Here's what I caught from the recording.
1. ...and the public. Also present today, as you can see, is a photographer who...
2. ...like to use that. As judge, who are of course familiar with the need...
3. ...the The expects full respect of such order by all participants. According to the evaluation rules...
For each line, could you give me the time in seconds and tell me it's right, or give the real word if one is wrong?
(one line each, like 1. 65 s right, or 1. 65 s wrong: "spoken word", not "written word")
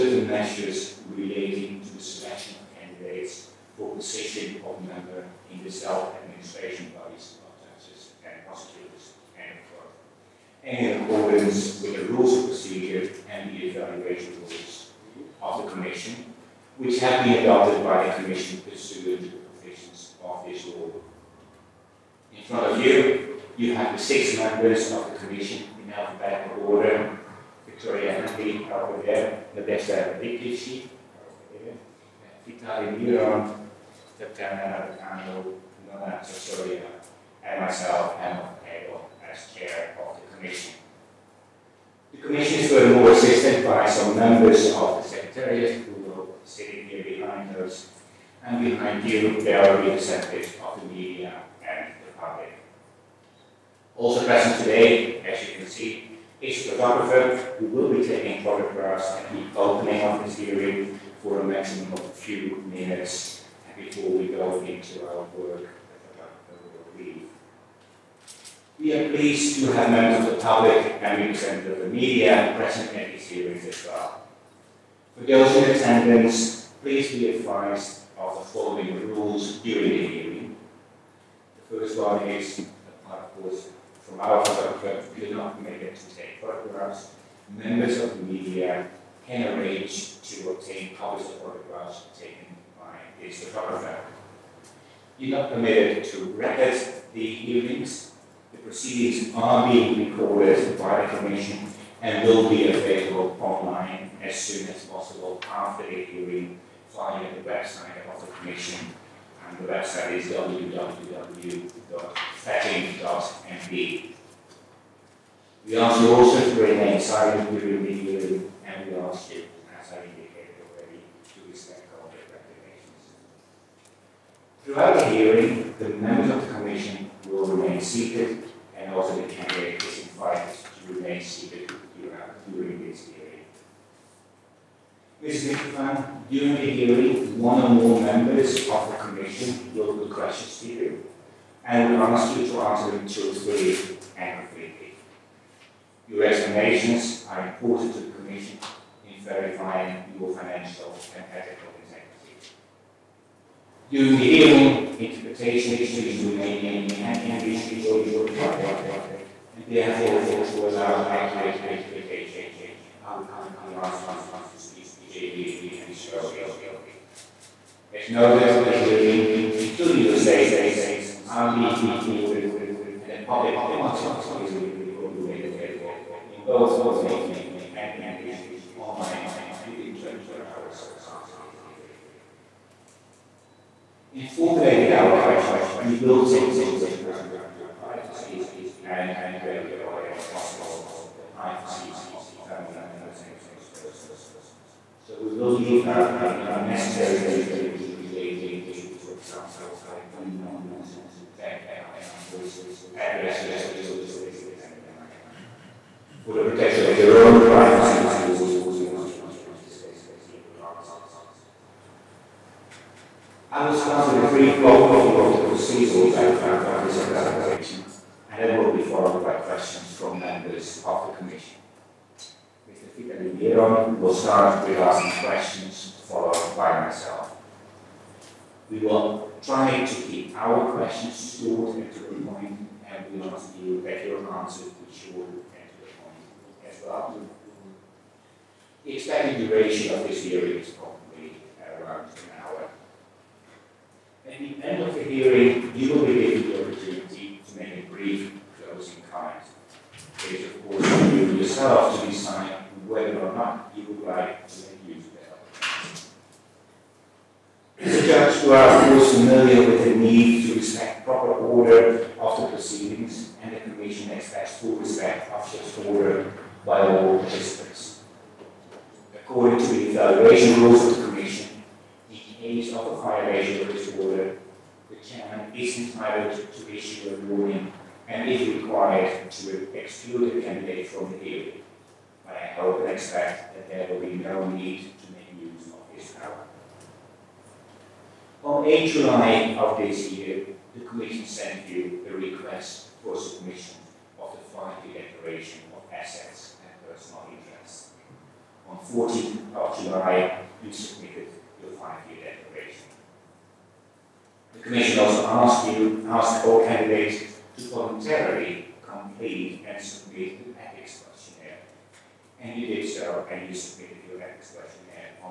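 1. 51 s right
2. 254 s right
3. 263 s wrong: "Commission", not "The".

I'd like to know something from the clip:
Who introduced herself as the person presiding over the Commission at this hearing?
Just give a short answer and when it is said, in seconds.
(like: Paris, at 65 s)
Emma Hegel, at 38 s.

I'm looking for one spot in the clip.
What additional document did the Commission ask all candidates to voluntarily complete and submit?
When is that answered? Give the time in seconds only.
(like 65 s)
314 s.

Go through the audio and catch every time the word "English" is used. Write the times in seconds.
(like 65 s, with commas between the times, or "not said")
157 s, 178 s.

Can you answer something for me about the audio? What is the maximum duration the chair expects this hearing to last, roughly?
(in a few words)
an hour.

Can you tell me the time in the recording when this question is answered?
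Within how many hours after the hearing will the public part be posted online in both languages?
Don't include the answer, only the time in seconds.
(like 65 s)
179 s.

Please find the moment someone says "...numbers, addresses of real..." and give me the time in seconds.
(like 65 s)
201 s.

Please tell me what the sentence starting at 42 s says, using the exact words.
The commission is more assisted by some members of areas we will sitting here behind us.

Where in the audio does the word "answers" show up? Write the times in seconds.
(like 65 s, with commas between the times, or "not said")
142 s, 210 s, 234 s.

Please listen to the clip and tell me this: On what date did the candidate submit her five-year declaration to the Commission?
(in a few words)
14 July.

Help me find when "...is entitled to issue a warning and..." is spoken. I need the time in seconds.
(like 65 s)
275 s.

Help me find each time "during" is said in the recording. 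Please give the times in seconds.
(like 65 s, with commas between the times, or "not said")
79 s, 117 s, 136 s, 153 s.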